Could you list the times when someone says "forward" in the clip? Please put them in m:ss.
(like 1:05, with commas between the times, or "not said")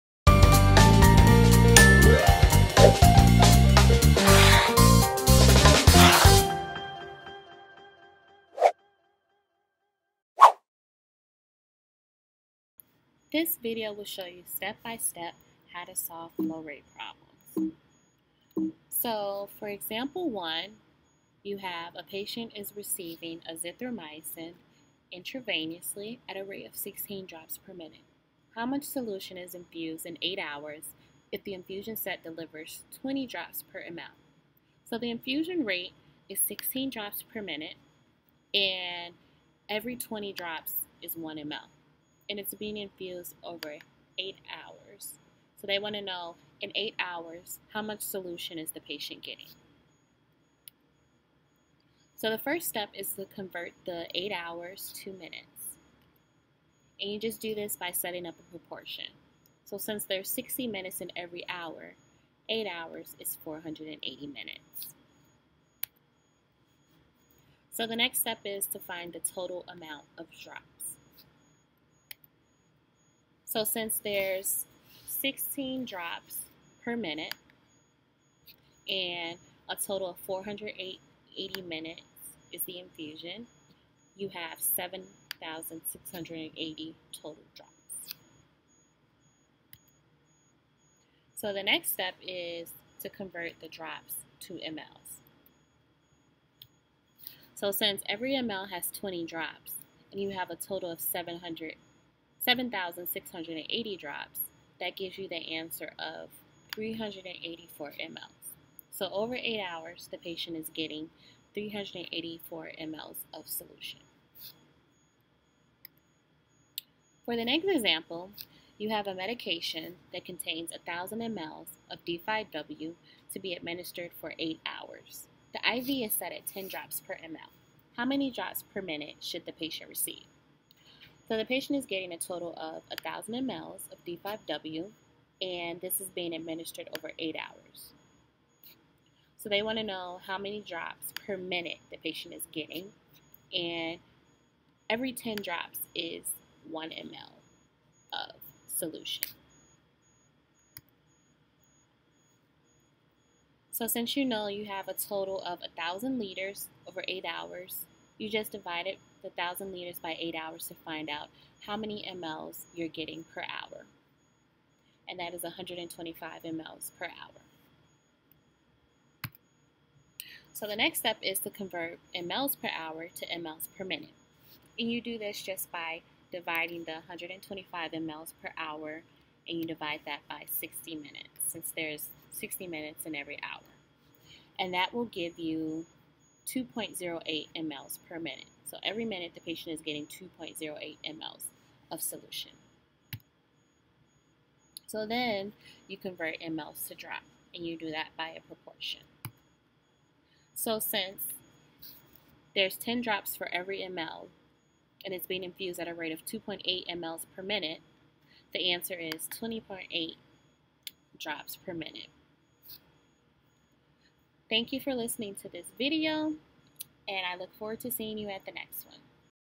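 3:37.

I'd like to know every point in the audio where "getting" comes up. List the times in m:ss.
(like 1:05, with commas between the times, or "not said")
0:49, 1:50, 2:11, 2:22, 2:42, 3:09.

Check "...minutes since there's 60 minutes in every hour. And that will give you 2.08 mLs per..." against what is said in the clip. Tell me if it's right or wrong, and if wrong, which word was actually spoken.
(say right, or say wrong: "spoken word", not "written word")
right.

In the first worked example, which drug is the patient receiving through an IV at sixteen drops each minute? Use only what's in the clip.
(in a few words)
Azithromycin.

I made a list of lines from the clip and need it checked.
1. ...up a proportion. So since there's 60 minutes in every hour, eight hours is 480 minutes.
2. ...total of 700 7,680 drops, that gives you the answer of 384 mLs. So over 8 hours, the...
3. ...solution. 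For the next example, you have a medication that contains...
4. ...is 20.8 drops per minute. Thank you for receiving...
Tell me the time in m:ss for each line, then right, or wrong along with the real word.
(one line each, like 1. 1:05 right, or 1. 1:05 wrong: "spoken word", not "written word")
1. 0:58 right
2. 1:40 right
3. 1:53 right
4. 3:28 wrong: "listening", not "receiving".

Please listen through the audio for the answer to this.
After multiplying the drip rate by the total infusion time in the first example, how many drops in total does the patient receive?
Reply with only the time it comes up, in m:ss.
1:24.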